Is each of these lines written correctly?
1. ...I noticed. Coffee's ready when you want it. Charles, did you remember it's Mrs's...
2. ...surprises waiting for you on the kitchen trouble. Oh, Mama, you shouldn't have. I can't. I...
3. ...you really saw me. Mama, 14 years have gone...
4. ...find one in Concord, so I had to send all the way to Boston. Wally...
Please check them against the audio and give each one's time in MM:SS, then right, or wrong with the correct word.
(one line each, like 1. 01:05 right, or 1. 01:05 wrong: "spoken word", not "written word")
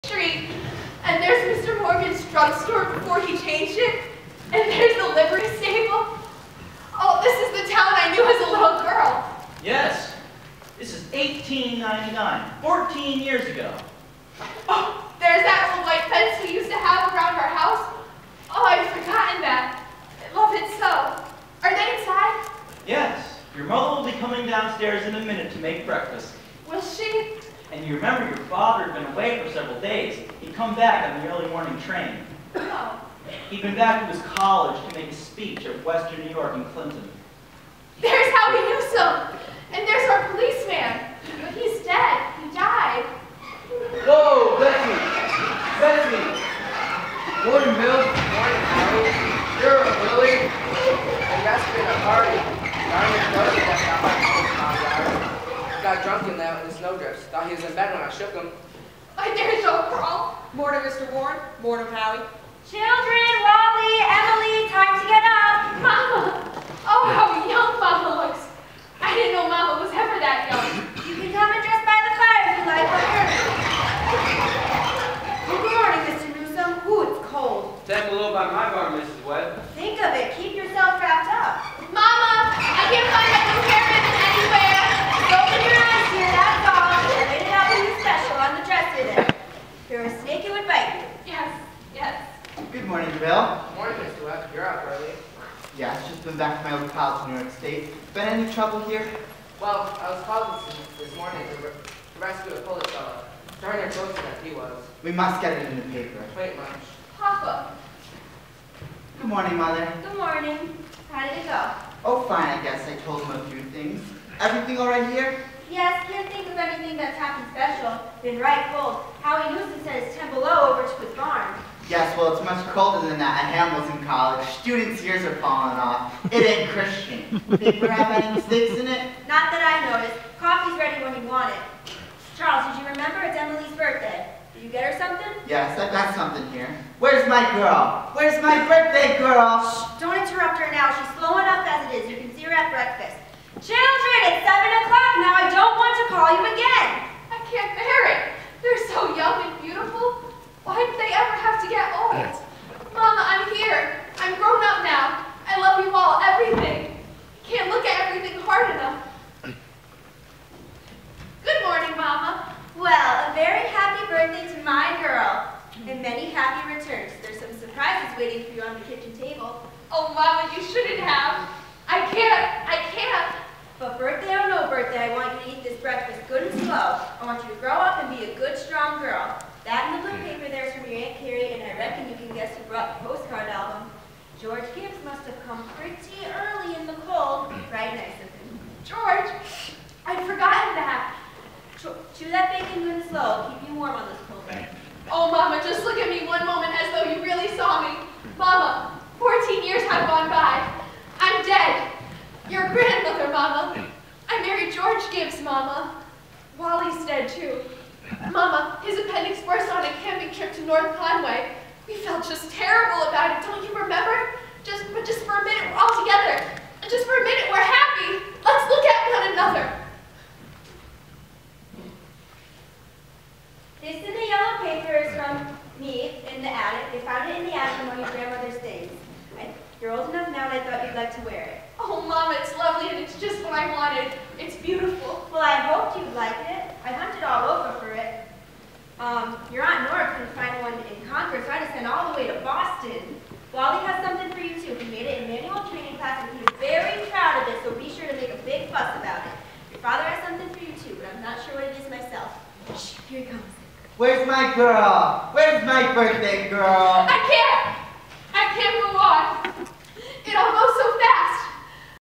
1. 02:09 wrong: "Emily", not "Mrs"
2. 02:47 wrong: "table", not "trouble"
3. 03:17 right
4. 04:00 right.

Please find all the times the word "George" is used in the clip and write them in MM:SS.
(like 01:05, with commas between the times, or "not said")
03:04, 03:24.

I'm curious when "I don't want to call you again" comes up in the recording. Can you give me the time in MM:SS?
02:25.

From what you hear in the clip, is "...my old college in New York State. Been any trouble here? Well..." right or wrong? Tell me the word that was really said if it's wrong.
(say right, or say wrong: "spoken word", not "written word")
right.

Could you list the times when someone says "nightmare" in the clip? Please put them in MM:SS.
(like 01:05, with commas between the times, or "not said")
not said.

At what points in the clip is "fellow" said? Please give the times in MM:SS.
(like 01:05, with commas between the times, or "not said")
01:42.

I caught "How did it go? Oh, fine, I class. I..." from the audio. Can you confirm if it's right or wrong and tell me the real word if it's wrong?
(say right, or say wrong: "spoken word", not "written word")
wrong: "guess", not "class".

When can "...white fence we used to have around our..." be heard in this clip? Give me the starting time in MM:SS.
00:15.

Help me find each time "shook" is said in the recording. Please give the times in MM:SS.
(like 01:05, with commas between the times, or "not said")
00:58.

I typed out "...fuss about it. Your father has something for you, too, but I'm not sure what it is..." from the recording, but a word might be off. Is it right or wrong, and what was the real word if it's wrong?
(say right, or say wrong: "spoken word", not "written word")
right.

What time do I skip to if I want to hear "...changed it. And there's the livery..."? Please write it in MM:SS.
00:03.